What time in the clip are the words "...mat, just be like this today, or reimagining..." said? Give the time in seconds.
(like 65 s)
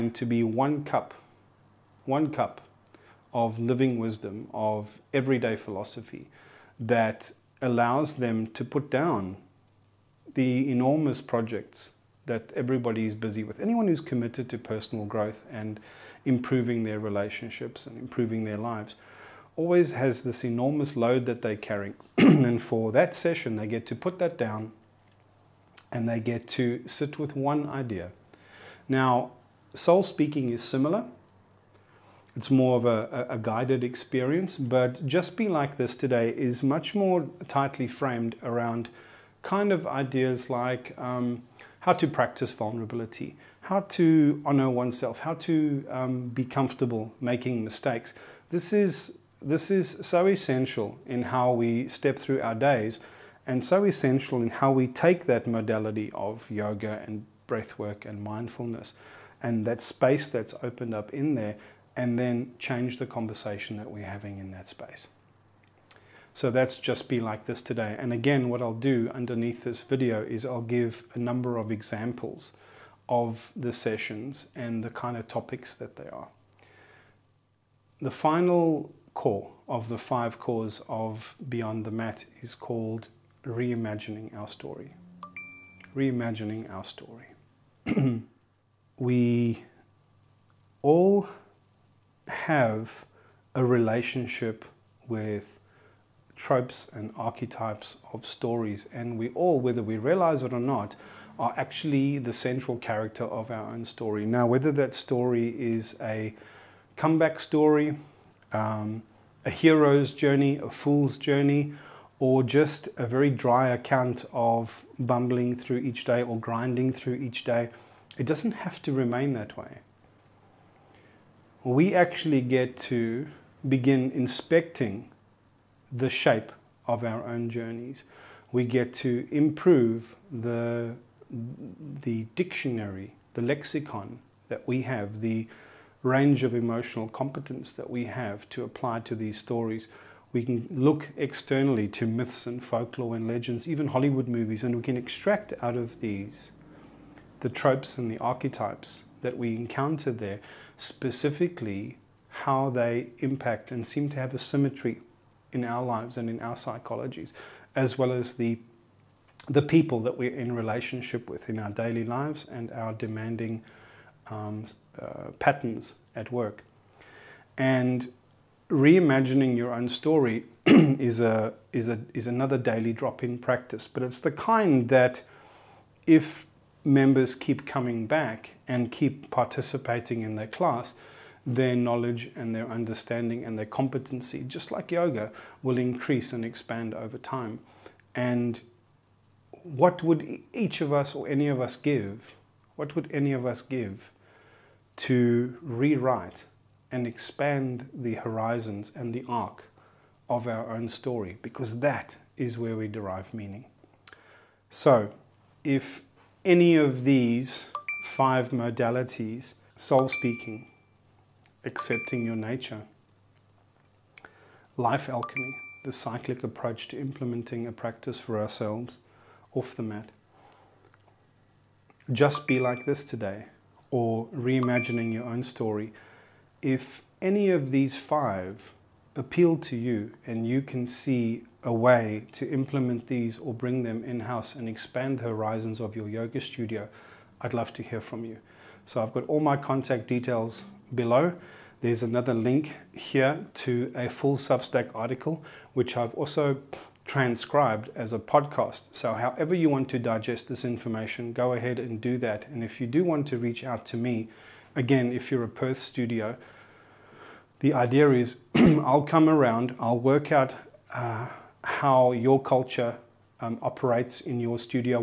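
219 s.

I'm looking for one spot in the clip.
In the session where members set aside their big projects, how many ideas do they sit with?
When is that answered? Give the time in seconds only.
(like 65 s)
27 s.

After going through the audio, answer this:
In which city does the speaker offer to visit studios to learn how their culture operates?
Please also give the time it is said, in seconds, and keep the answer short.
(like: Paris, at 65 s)
Perth, at 255 s.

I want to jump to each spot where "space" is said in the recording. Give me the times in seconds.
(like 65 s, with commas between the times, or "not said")
59 s, 64 s.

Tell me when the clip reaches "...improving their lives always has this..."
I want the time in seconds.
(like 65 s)
17 s.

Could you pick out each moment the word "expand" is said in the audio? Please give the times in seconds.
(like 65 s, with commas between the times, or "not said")
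186 s, 197 s, 234 s.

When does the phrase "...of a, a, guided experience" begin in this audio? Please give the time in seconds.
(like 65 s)
32 s.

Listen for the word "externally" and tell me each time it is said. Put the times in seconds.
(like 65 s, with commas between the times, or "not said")
141 s.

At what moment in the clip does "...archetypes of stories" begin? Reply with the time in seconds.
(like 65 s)
97 s.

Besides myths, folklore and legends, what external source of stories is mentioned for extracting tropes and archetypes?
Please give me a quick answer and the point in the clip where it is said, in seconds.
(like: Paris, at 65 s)
Hollywood movies, at 143 s.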